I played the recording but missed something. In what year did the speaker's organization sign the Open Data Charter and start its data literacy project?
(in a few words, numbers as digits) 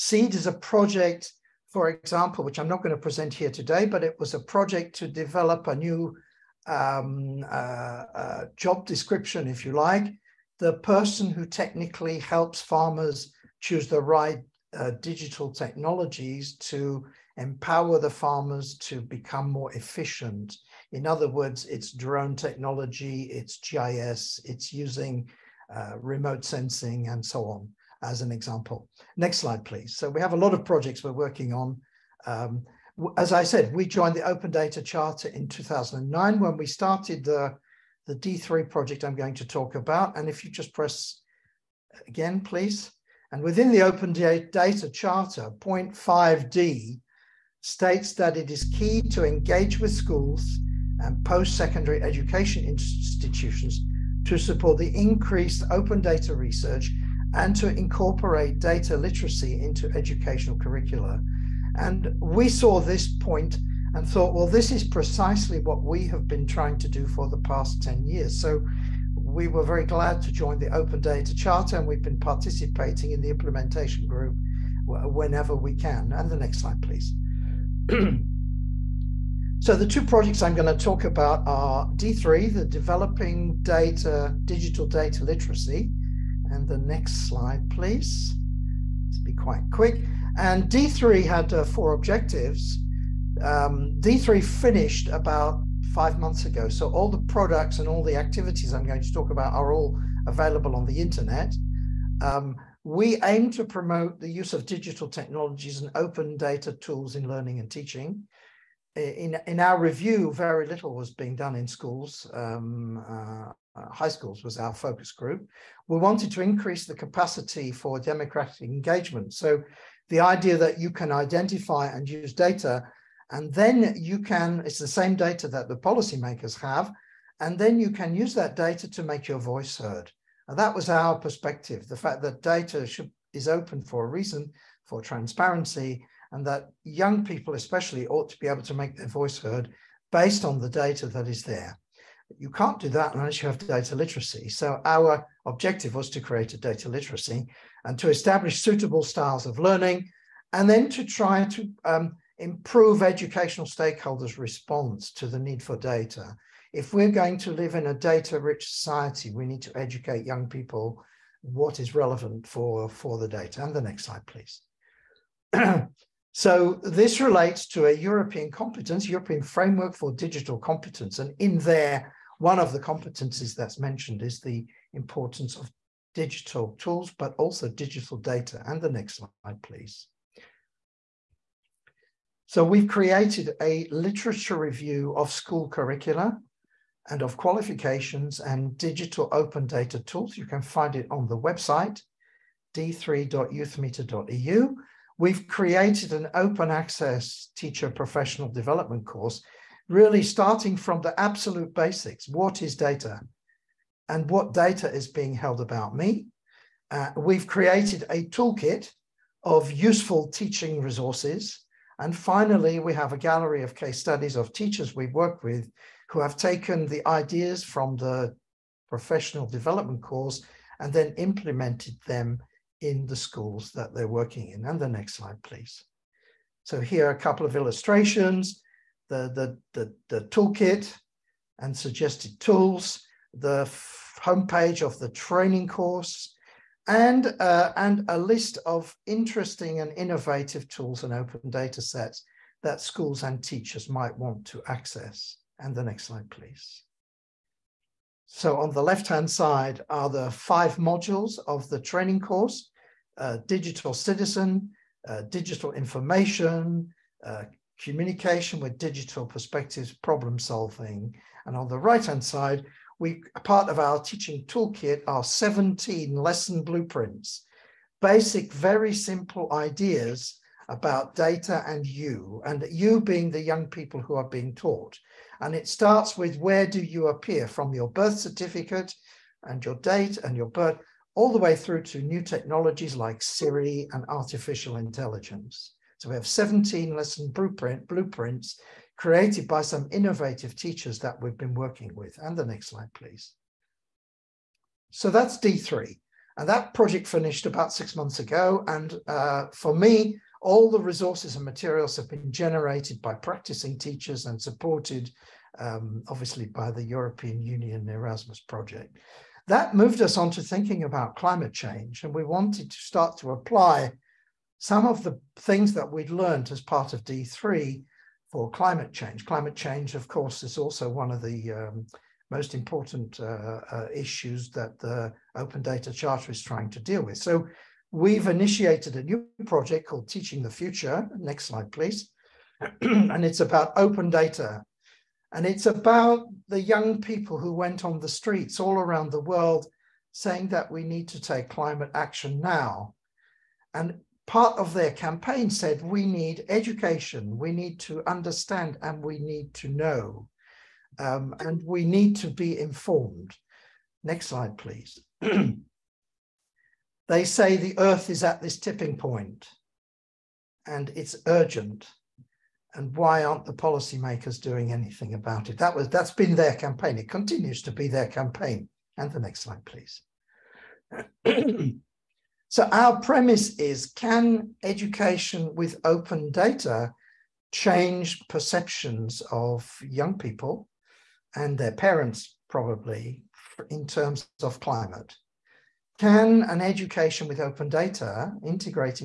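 2009.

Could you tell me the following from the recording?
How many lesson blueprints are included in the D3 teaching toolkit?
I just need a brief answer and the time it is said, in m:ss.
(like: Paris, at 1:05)
17, at 4:25.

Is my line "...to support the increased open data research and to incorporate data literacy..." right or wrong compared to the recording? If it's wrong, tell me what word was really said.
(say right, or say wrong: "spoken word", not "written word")
right.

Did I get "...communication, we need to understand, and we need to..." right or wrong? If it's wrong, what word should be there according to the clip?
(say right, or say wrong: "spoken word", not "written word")
wrong: "education", not "communication".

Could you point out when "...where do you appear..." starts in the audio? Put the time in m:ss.
4:36.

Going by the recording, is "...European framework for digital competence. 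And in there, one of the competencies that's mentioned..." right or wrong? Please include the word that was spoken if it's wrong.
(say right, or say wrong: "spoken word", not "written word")
right.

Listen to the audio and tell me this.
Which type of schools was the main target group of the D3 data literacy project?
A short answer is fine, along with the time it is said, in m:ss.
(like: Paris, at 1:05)
High schools, at 1:53.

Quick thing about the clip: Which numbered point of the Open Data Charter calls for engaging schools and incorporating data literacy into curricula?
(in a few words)
5D.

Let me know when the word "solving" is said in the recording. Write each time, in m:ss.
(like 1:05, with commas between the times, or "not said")
4:20.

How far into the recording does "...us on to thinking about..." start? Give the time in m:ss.
5:10.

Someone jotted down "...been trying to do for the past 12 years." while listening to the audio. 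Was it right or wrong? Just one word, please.
wrong.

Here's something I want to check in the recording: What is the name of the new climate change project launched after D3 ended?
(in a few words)
Teaching the Future.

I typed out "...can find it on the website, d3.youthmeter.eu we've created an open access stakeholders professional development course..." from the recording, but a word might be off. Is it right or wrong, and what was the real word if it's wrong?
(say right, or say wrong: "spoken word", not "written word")
wrong: "teacher", not "stakeholders".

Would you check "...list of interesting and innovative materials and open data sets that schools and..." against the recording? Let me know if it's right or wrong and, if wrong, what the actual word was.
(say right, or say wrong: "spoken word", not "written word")
wrong: "tools", not "materials".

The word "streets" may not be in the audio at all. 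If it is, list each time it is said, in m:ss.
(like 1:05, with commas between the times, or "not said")
5:38.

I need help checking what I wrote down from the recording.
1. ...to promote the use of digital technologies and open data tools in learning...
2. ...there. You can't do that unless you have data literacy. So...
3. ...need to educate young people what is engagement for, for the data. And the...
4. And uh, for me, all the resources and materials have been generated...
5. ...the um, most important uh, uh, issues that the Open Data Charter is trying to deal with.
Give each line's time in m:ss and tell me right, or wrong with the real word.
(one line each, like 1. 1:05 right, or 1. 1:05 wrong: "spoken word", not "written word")
1. 1:43 right
2. 2:21 right
3. 2:39 wrong: "relevant", not "engagement"
4. 4:58 right
5. 5:21 right.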